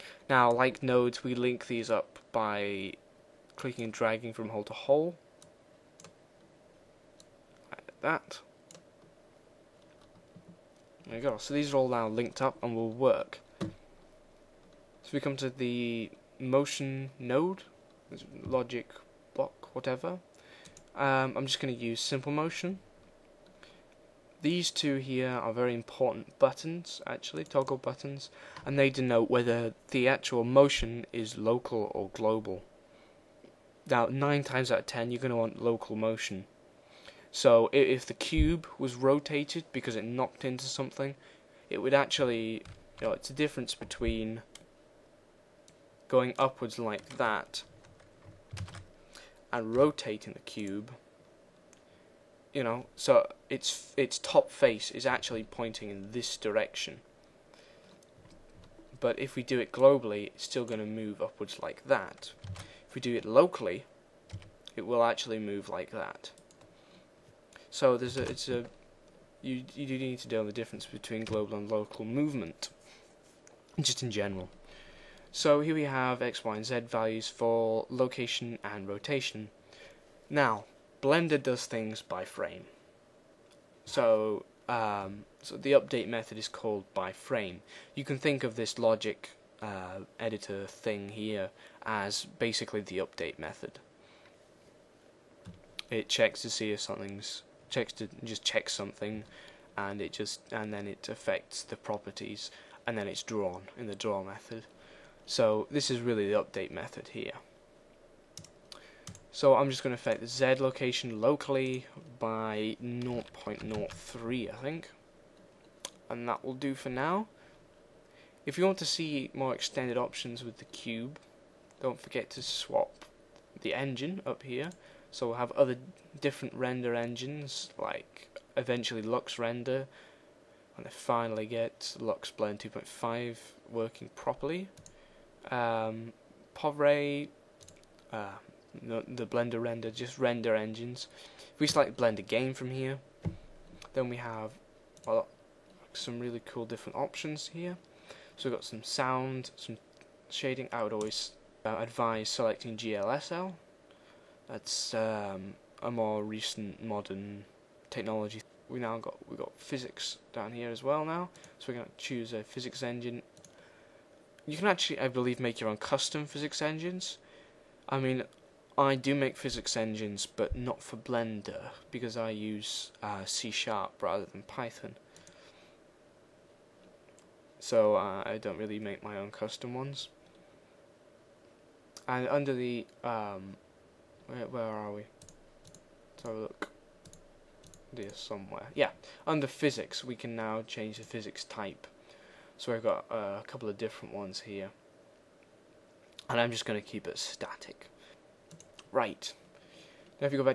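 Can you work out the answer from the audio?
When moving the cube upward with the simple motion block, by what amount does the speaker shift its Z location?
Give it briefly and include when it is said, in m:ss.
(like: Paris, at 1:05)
0.03, at 1:52.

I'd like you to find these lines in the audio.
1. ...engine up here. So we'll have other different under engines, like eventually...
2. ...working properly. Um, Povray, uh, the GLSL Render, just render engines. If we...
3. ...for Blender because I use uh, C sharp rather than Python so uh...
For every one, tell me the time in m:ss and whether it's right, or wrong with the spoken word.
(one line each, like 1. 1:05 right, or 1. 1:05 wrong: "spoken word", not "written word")
1. 2:03 wrong: "render", not "under"
2. 2:13 wrong: "Blender", not "GLSL"
3. 2:50 right.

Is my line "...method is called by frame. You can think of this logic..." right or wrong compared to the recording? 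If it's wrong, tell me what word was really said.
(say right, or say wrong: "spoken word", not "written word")
right.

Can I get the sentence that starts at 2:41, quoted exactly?
So we're gonna choose a physics engine.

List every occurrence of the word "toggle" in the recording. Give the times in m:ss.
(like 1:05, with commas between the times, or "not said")
0:27.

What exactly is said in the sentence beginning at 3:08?
Yeah, under physics we can now change the physics type.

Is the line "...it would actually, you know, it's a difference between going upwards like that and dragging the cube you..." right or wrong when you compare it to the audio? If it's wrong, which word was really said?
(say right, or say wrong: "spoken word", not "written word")
wrong: "rotating", not "dragging".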